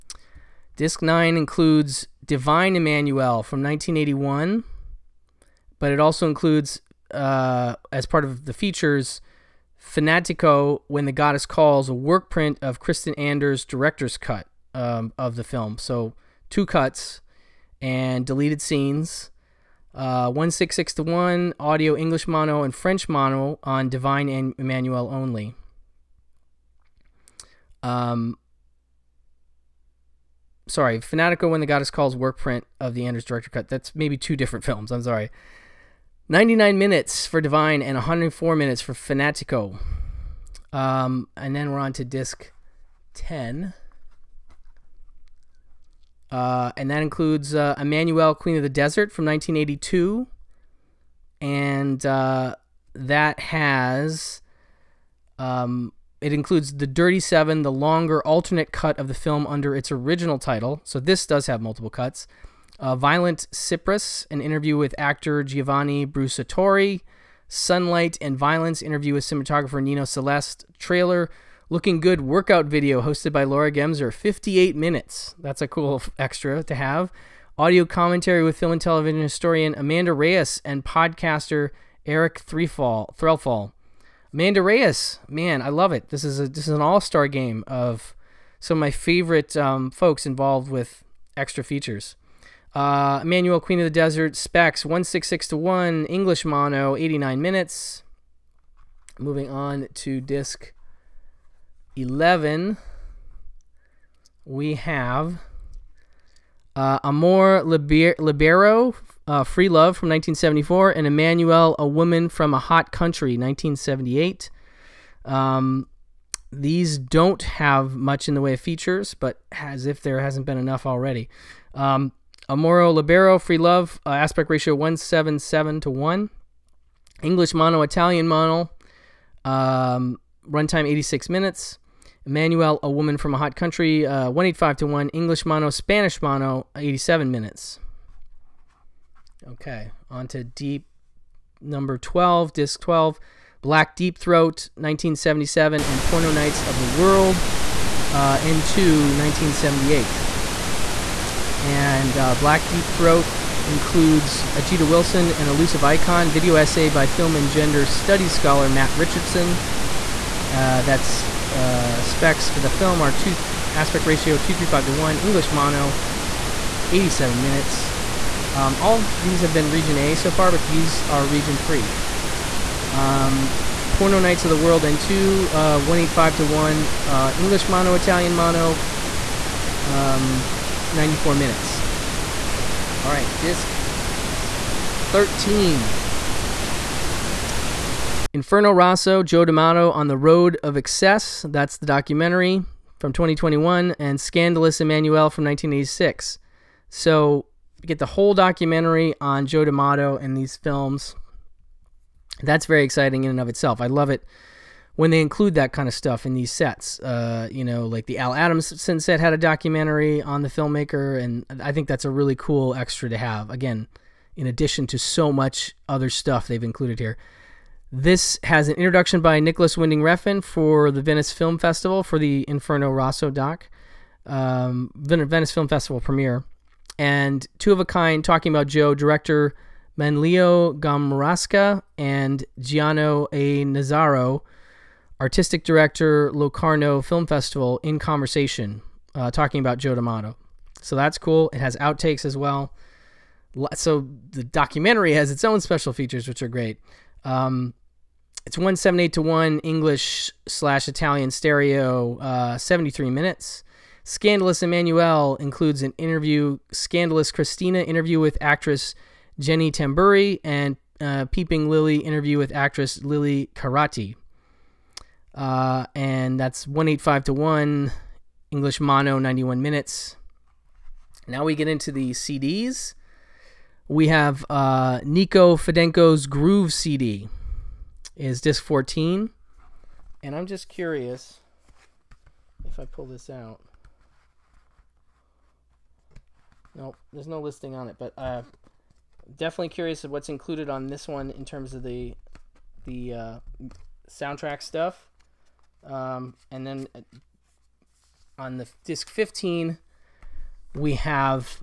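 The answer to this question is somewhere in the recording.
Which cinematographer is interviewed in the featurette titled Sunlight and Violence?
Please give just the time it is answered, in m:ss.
1:09.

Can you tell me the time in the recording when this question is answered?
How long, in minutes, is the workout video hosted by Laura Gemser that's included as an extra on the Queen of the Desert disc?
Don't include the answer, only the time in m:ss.
1:14.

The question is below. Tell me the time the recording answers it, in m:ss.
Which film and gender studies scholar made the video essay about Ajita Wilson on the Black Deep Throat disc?
2:38.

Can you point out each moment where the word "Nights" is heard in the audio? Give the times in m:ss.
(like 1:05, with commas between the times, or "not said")
2:26, 2:54.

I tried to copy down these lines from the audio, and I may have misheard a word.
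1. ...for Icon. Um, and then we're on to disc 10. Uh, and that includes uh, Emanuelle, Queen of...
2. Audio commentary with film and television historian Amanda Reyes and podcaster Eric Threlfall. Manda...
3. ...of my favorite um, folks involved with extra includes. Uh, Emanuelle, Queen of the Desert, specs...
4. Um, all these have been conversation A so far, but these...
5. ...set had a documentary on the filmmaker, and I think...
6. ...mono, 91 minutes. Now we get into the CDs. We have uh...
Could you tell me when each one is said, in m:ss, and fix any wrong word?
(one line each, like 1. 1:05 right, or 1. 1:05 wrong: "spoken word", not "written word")
1. 0:38 wrong: "Fanatico", not "Icon"
2. 1:17 right
3. 1:28 wrong: "features", not "includes"
4. 2:48 wrong: "region", not "conversation"
5. 3:28 right
6. 4:28 right.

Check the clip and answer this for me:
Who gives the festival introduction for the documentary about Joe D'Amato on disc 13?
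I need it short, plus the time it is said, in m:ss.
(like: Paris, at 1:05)
Nicolas Winding Refn, at 3:39.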